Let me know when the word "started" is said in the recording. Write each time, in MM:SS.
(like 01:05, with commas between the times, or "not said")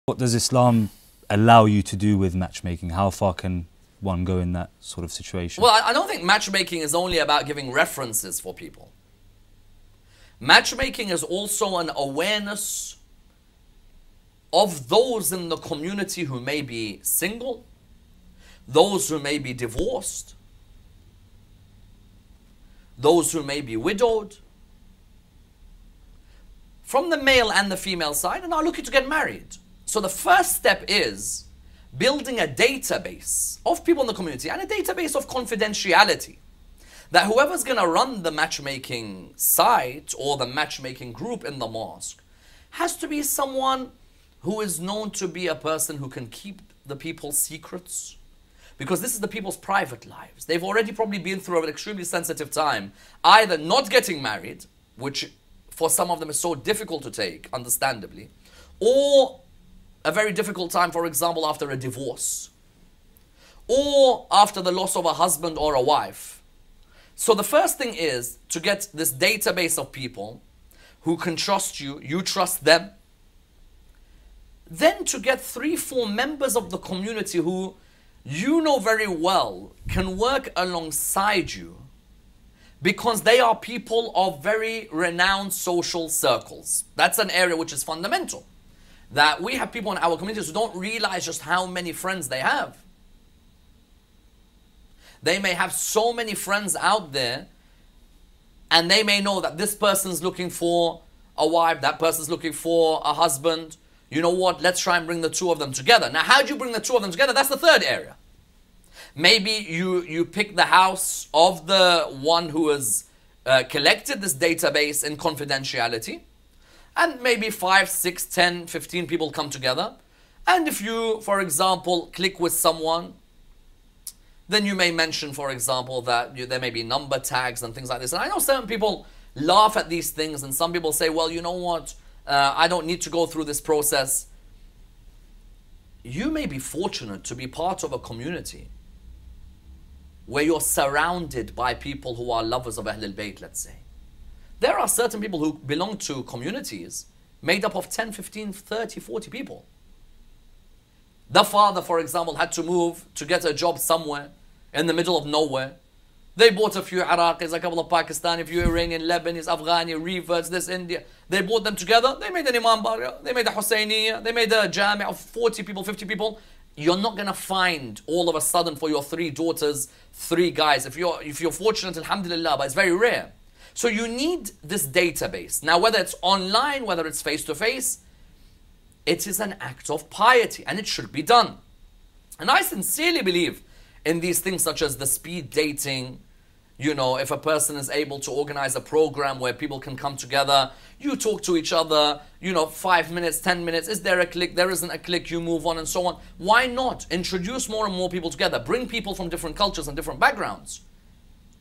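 not said.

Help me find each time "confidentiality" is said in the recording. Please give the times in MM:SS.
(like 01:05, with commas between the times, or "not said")
00:35, 01:55.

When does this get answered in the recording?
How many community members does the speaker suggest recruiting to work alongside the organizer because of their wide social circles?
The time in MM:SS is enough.
01:15.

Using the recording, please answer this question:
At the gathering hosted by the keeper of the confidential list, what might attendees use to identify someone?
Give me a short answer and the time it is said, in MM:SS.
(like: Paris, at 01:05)
Number tags, at 02:06.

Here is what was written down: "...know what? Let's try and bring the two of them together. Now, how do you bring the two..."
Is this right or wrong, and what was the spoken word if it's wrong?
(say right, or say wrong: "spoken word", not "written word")
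right.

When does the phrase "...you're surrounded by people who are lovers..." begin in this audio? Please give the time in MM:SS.
02:20.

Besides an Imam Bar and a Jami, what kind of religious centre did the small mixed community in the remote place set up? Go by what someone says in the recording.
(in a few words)
A Husseiniya.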